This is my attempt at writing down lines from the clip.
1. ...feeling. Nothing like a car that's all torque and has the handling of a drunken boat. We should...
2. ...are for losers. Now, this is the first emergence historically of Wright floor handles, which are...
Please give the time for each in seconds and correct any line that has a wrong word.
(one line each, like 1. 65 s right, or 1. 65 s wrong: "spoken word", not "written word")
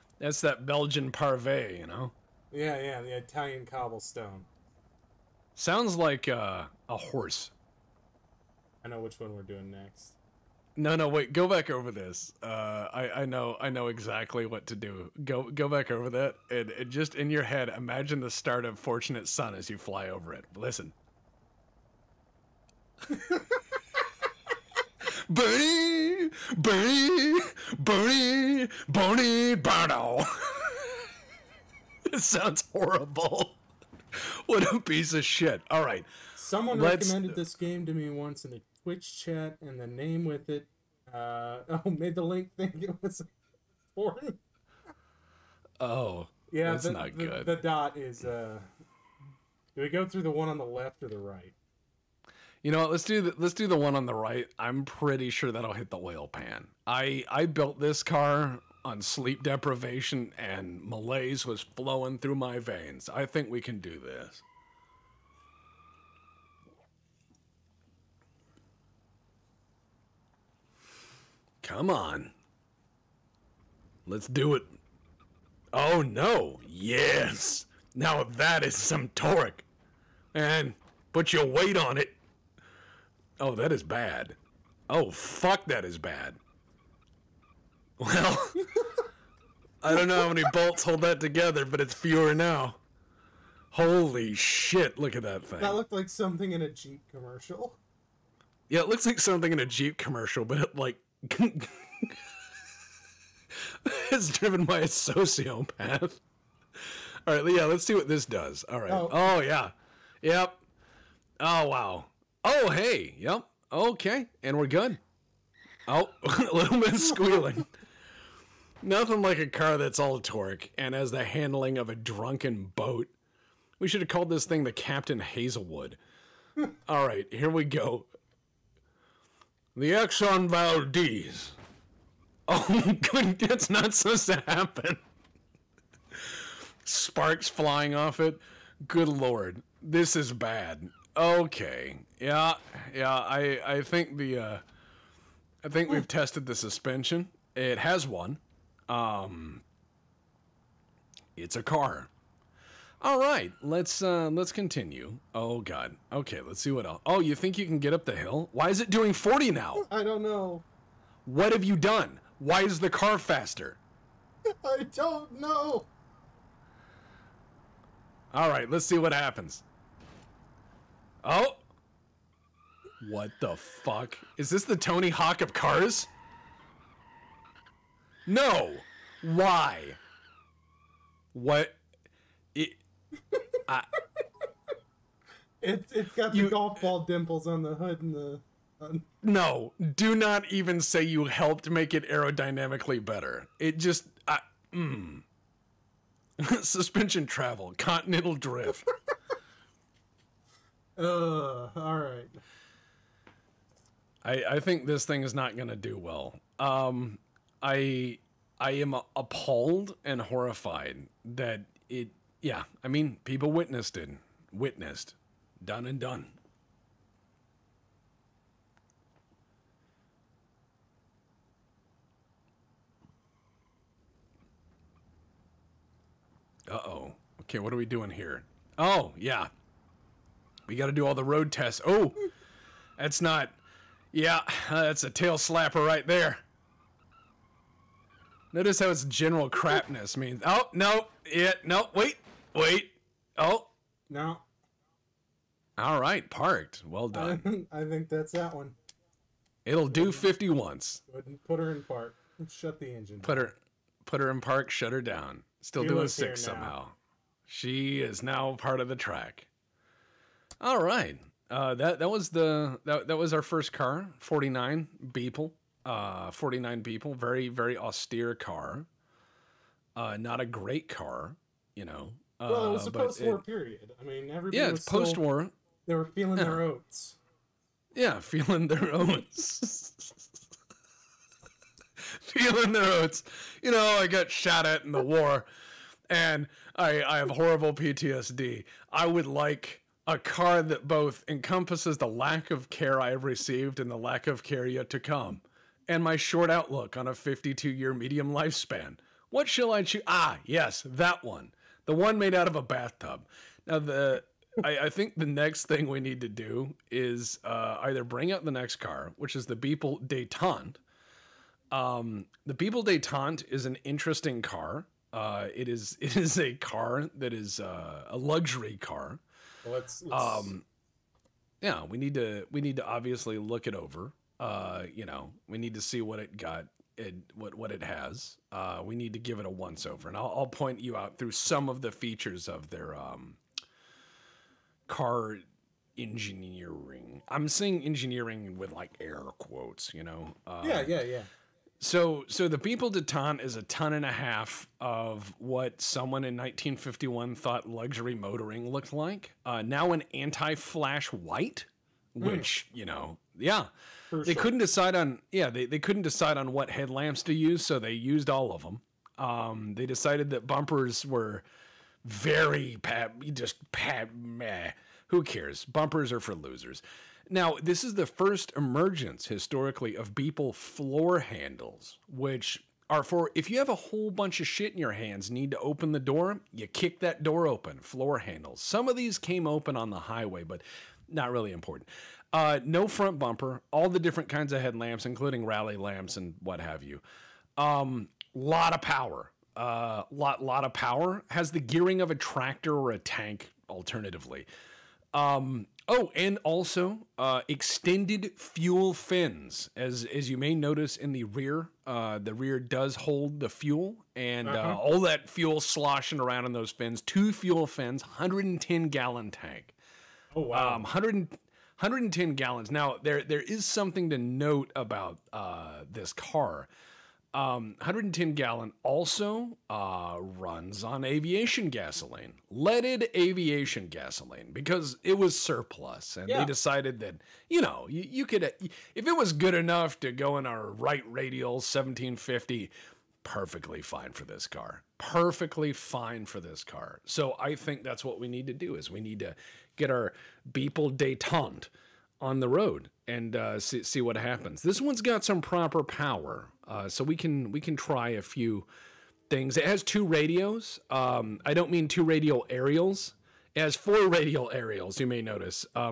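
1. 116 s wrong: "squealing", not "feeling"
2. 366 s wrong: "Beeple", not "Wright".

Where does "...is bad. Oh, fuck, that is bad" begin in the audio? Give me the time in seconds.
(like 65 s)
83 s.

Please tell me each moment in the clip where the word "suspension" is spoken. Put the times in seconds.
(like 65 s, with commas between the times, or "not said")
146 s, 196 s.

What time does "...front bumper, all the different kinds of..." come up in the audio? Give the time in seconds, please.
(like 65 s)
382 s.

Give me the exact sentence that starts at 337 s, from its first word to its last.
I'm saying engineering with like air quotes, you know.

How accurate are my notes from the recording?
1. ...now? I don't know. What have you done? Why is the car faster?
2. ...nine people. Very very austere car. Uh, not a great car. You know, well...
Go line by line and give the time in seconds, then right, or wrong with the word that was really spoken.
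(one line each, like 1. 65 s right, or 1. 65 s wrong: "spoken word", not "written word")
1. 159 s right
2. 266 s right.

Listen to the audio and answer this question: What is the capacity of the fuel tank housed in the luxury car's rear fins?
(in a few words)
110 gallons.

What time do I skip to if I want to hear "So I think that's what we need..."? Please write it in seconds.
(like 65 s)
437 s.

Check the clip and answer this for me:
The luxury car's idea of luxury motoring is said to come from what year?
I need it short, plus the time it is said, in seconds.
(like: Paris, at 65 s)
1951, at 346 s.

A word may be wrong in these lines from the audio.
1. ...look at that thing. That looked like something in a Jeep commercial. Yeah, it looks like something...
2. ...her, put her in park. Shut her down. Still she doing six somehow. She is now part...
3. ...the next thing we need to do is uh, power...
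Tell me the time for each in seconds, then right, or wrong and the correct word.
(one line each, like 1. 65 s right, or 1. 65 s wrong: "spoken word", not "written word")
1. 94 s right
2. 253 s right
3. 305 s wrong: "either", not "power".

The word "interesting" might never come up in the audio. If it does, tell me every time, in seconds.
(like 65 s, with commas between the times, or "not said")
313 s.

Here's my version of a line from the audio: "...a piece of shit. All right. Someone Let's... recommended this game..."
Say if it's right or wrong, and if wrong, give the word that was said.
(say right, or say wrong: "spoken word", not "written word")
right.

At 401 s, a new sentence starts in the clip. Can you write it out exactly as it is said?
Uh, the rear does hold the fuel, and uh, uh-huh.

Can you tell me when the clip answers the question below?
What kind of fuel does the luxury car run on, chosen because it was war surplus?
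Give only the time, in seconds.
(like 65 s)
422 s.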